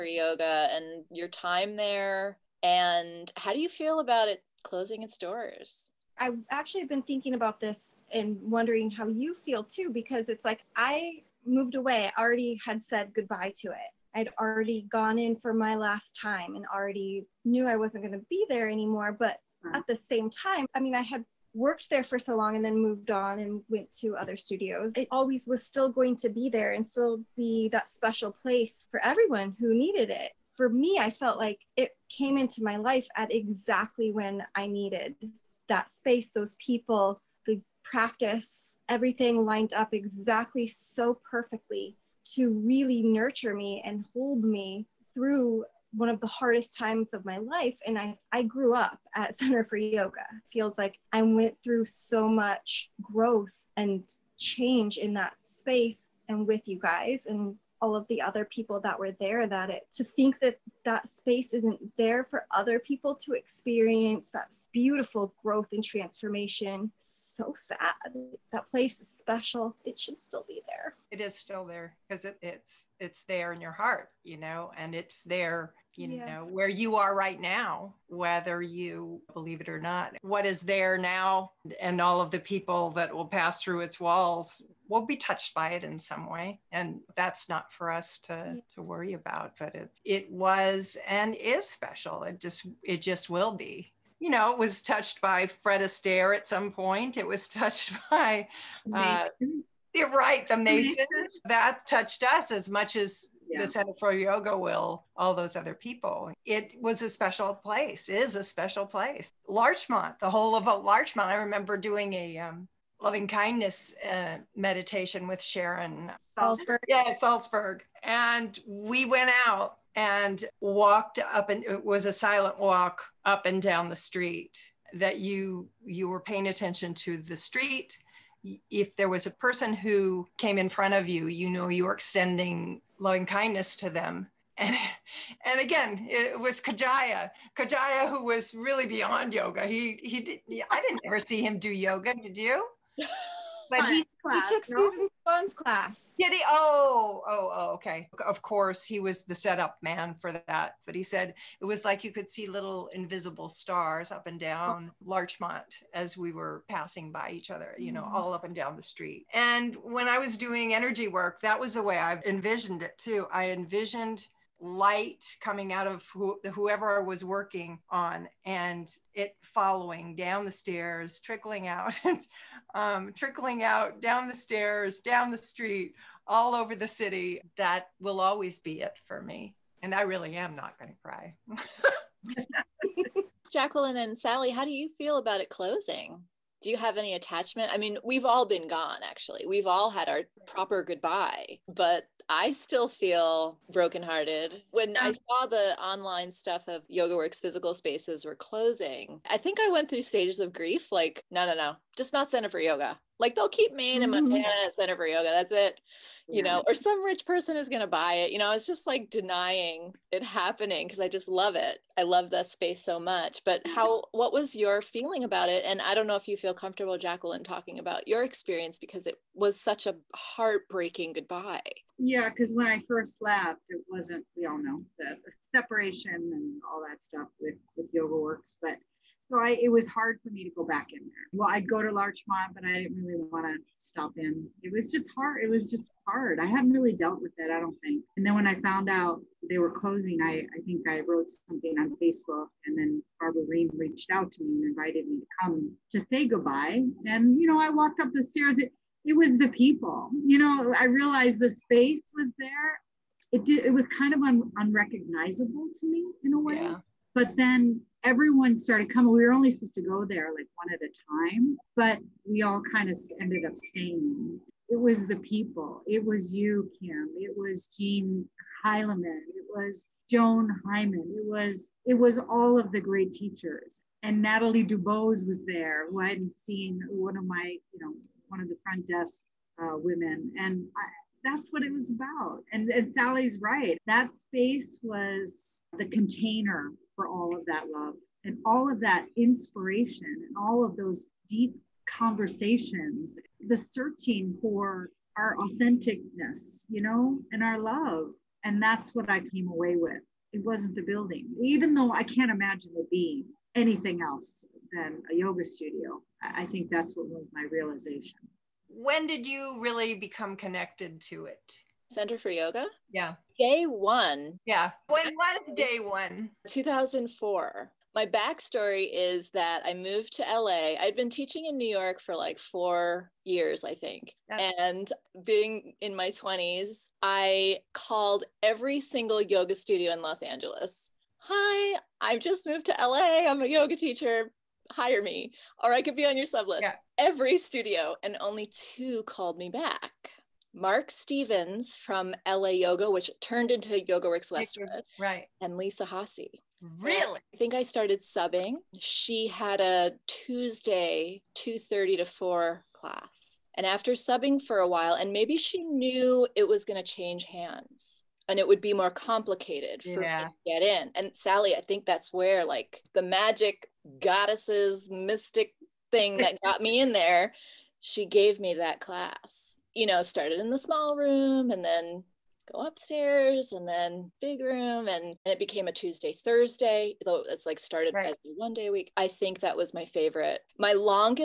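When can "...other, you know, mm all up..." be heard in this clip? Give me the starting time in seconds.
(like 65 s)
157 s.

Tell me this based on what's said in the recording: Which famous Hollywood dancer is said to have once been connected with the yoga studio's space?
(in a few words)
Fred Astaire.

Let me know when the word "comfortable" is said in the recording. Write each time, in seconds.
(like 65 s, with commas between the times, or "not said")
216 s.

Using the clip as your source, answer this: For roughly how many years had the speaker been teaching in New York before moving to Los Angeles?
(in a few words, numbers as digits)
4.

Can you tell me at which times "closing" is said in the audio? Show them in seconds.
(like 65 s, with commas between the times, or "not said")
4 s, 185 s, 198 s, 239 s.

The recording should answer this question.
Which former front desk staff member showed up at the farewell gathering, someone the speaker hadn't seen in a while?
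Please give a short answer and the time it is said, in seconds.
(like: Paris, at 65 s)
Natalie Dubose, at 274 s.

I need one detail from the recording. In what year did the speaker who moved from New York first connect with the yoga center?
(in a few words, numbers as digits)
2004.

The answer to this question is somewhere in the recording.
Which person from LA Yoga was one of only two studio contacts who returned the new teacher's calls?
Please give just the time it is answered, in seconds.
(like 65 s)
340 s.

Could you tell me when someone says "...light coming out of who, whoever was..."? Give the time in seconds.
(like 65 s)
164 s.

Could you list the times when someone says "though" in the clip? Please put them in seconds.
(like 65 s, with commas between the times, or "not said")
301 s, 377 s.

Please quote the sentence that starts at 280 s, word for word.
And I, that's what it was about.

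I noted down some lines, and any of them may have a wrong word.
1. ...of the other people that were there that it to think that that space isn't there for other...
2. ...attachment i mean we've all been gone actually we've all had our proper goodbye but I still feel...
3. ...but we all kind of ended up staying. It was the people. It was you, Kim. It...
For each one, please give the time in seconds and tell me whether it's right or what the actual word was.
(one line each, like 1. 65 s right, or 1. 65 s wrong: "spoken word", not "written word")
1. 57 s right
2. 187 s right
3. 261 s right.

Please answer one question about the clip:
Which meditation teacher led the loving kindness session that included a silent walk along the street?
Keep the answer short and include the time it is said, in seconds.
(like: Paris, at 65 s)
Sharon Salzberg, at 115 s.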